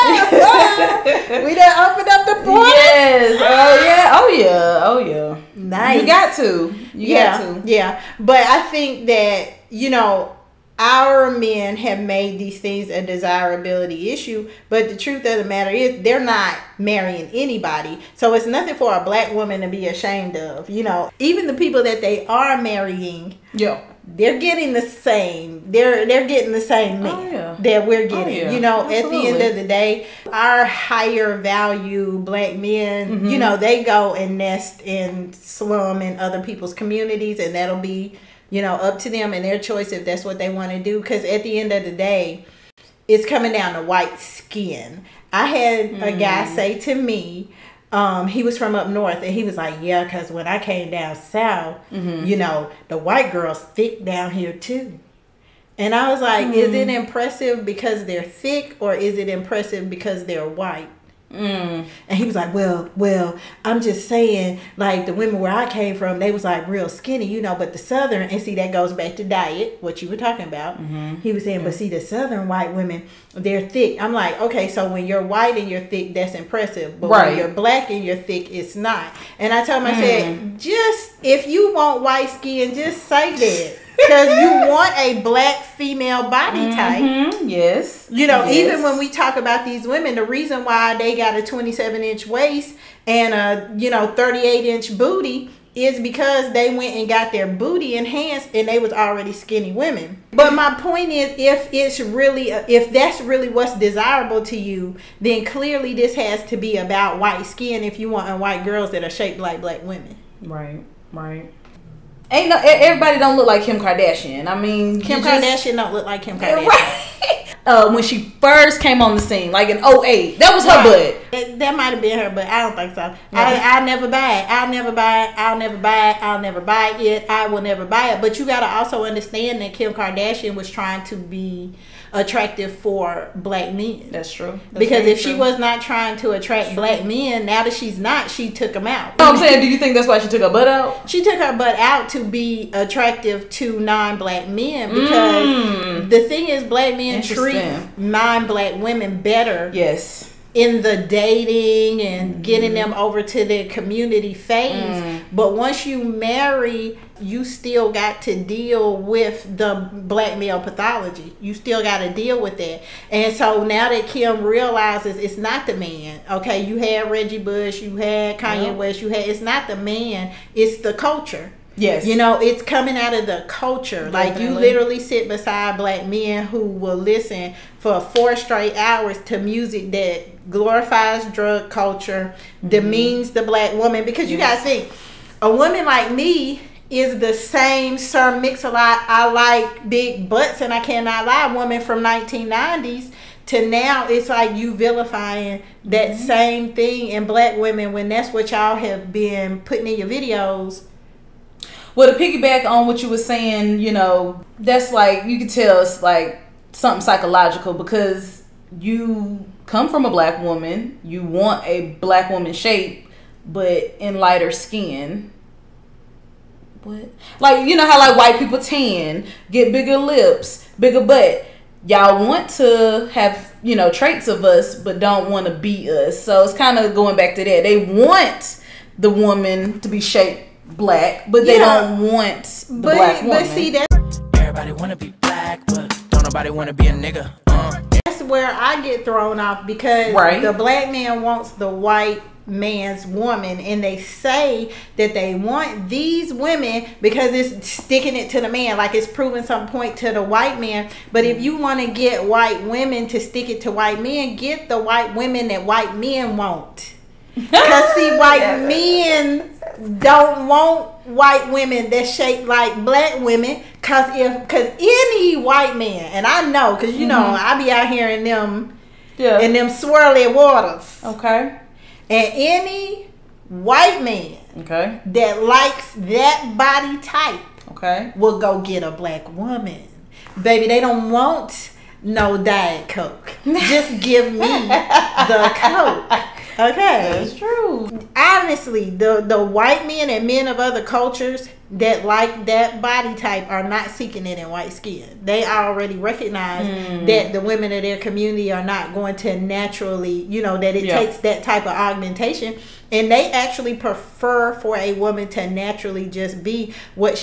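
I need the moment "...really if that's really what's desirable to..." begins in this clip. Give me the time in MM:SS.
01:41.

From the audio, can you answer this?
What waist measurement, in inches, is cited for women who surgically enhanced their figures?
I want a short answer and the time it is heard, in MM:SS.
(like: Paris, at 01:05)
27 inch, at 01:31.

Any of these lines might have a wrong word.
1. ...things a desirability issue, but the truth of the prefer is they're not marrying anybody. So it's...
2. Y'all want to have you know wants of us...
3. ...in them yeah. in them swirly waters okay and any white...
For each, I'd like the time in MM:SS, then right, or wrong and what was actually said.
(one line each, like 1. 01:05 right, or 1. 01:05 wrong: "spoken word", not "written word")
1. 00:12 wrong: "matter", not "prefer"
2. 03:41 wrong: "traits", not "wants"
3. 04:28 right.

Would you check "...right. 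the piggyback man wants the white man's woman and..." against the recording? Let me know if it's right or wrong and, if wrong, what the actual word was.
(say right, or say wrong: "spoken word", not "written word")
wrong: "black", not "piggyback".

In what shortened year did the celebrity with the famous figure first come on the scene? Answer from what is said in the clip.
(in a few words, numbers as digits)
08.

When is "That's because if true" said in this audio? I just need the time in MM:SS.
02:14.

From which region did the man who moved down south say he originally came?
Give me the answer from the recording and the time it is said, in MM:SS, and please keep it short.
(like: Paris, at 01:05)
up north, at 00:48.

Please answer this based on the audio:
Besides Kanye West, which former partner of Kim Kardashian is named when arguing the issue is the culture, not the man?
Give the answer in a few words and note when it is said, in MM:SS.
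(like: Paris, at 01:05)
Reggie Bush, at 02:47.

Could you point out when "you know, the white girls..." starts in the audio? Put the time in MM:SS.
00:52.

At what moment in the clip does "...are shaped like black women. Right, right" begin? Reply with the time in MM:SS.
01:49.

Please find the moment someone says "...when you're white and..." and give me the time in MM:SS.
01:14.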